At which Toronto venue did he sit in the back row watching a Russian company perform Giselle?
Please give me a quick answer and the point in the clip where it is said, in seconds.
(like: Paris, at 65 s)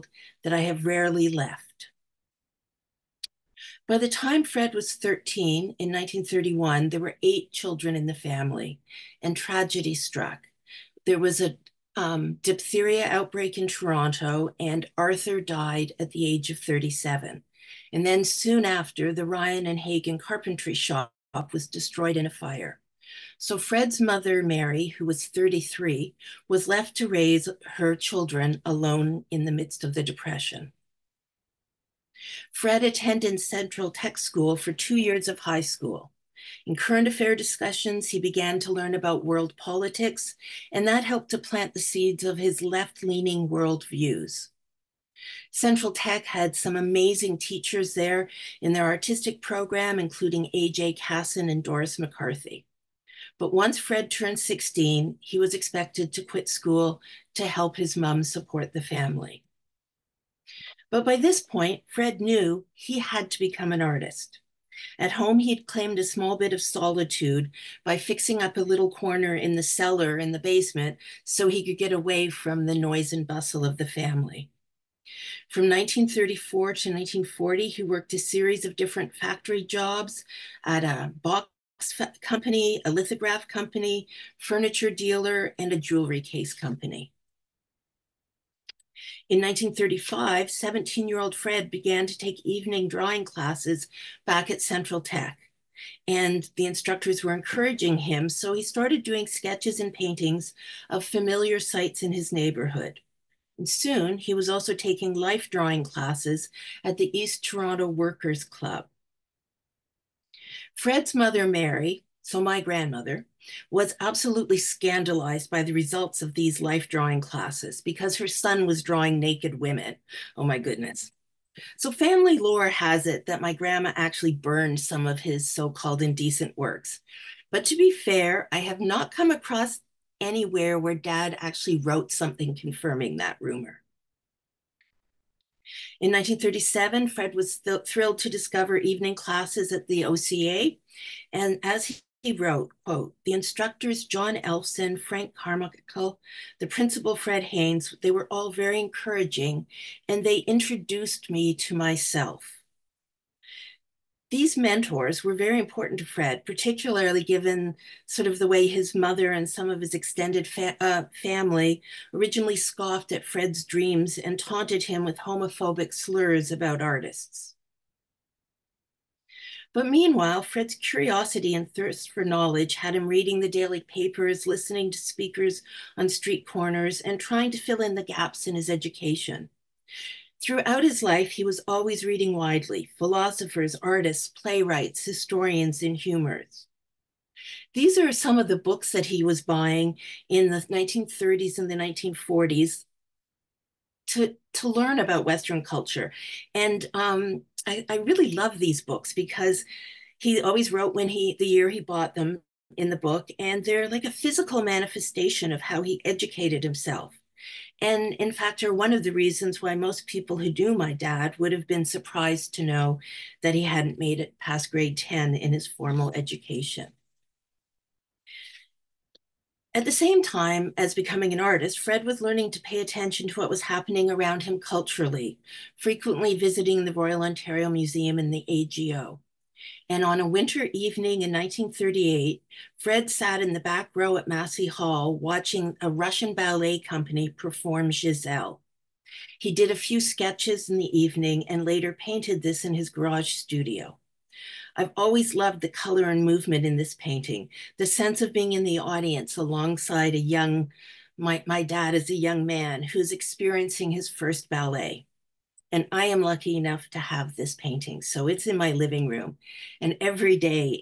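Massey Hall, at 234 s.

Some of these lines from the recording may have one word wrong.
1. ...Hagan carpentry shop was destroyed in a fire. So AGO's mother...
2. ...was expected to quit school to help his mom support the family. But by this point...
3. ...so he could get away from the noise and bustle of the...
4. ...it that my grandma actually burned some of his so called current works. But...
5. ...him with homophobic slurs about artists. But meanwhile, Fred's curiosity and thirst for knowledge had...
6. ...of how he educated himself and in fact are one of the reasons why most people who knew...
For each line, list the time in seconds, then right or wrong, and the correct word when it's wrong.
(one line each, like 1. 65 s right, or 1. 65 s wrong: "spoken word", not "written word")
1. 19 s wrong: "Fred", not "AGO"
2. 55 s right
3. 71 s right
4. 123 s wrong: "indecent", not "current"
5. 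164 s right
6. 205 s right.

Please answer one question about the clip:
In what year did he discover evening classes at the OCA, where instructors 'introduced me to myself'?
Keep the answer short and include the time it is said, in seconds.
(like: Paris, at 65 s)
1937, at 136 s.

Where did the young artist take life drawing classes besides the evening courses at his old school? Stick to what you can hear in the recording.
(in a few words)
East Toronto Workers Club.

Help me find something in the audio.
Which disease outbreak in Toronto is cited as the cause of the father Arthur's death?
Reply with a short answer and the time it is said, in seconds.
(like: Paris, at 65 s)
Diphtheria, at 12 s.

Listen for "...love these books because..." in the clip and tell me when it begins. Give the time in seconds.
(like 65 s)
198 s.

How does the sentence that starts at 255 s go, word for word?
And I am lucky enough to have this painting.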